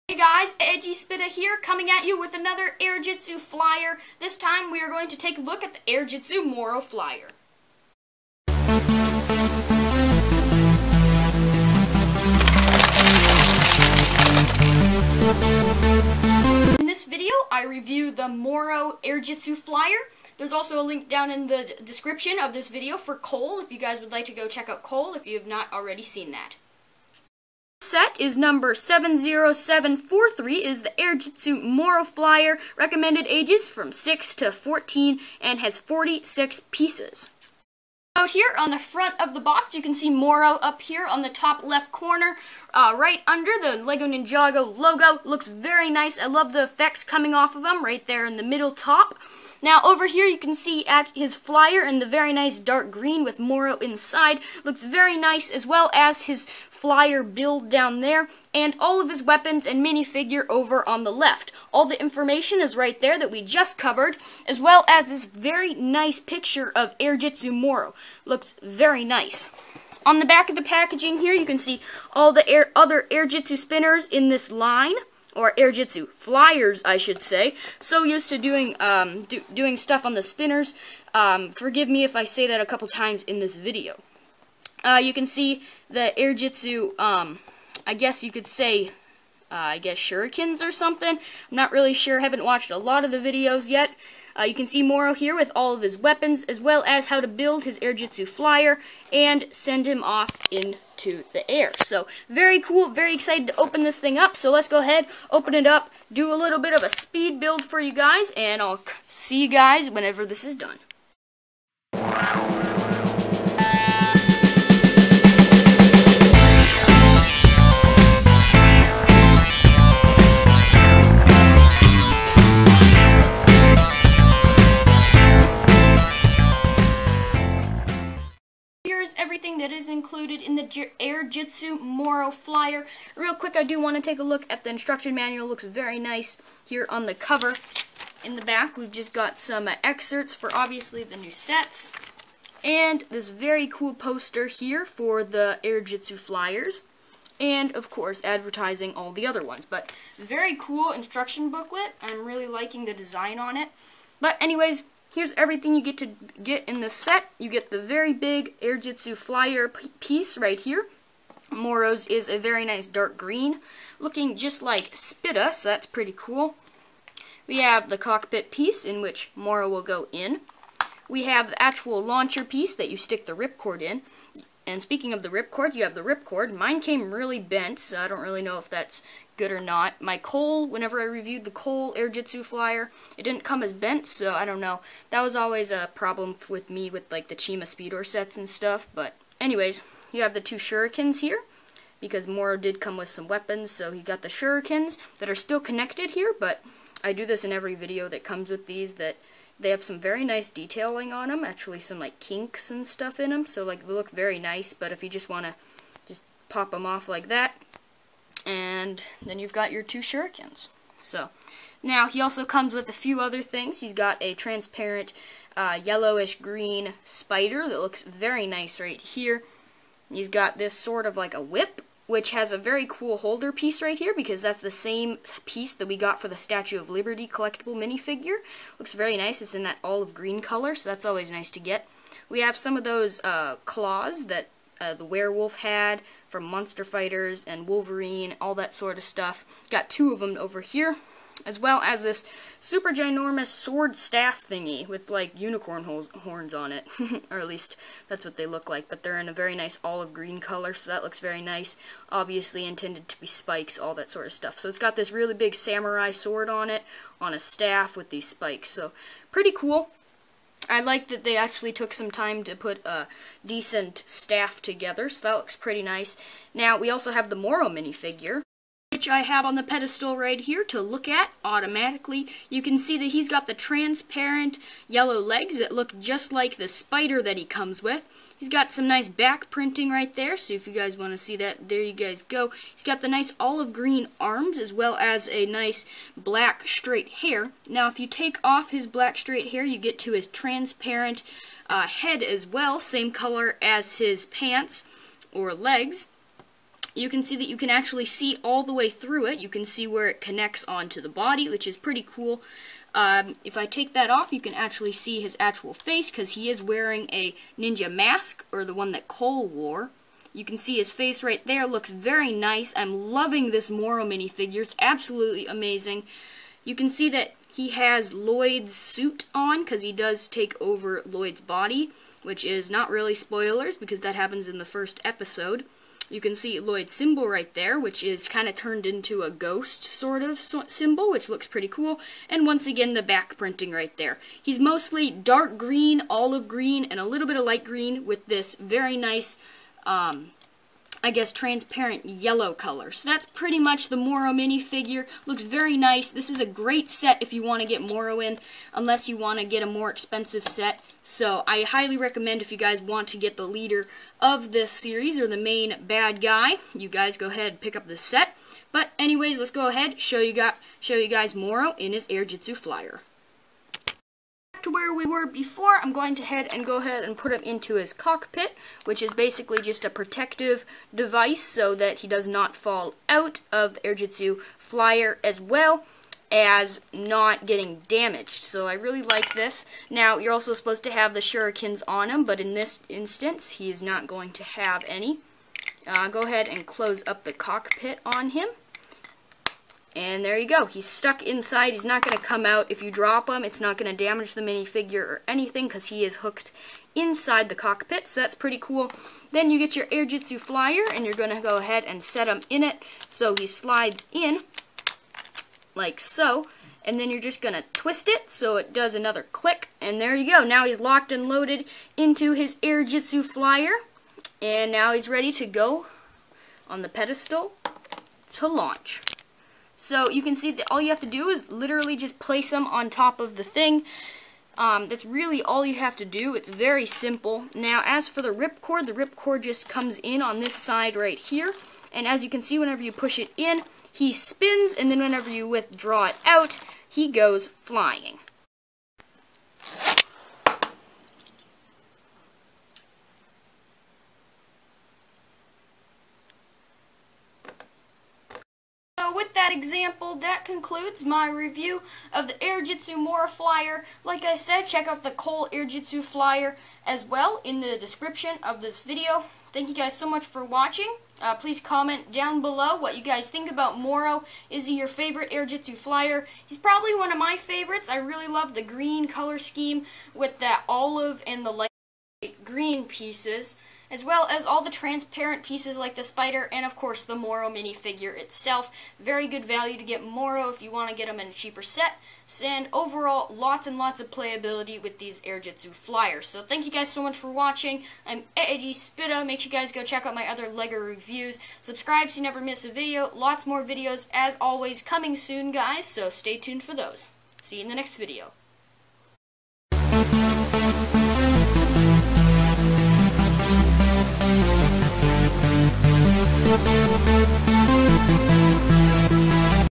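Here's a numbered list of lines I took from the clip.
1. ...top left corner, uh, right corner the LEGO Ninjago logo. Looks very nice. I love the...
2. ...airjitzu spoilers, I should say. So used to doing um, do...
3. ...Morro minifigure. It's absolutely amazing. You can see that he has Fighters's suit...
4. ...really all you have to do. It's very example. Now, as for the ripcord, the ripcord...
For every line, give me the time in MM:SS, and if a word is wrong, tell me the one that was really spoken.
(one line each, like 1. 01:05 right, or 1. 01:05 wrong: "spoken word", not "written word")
1. 00:41 wrong: "under", not "corner"
2. 01:15 wrong: "flyers", not "spoilers"
3. 05:13 wrong: "Lloyd", not "Fighters"
4. 07:05 wrong: "simple", not "example".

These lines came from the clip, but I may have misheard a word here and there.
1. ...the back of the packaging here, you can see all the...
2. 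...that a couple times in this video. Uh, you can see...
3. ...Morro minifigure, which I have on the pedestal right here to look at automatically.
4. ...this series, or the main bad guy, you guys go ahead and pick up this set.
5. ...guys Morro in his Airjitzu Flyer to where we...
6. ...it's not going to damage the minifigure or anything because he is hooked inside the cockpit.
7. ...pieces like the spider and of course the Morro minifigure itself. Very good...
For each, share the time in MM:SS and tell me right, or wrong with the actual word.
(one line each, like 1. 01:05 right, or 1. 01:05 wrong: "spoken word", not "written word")
1. 01:10 right
2. 01:22 right
3. 04:27 right
4. 05:54 right
5. 06:01 right
6. 06:33 right
7. 07:55 right.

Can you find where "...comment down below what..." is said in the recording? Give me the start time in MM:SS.
07:41.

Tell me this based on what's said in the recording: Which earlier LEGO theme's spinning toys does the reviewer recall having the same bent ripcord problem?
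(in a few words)
Chima Speedorz.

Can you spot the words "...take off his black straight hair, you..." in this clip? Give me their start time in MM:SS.
04:48.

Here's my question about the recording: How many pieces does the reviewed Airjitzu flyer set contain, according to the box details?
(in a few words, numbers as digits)
46.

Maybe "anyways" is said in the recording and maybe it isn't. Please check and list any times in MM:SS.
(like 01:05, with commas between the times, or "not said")
02:34, 03:09, 05:58.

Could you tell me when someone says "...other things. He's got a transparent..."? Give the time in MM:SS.
03:33.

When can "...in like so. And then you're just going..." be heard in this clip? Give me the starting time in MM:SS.
06:44.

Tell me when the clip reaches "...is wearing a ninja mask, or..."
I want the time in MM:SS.
05:06.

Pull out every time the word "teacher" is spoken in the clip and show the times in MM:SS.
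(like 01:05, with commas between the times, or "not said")
not said.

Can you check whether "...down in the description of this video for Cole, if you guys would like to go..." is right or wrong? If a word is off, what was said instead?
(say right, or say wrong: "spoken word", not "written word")
right.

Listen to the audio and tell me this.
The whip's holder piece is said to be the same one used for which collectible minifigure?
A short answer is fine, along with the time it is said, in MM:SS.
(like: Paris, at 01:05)
Statue of Liberty, at 03:46.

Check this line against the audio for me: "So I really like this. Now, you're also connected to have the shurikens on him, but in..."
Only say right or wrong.
wrong.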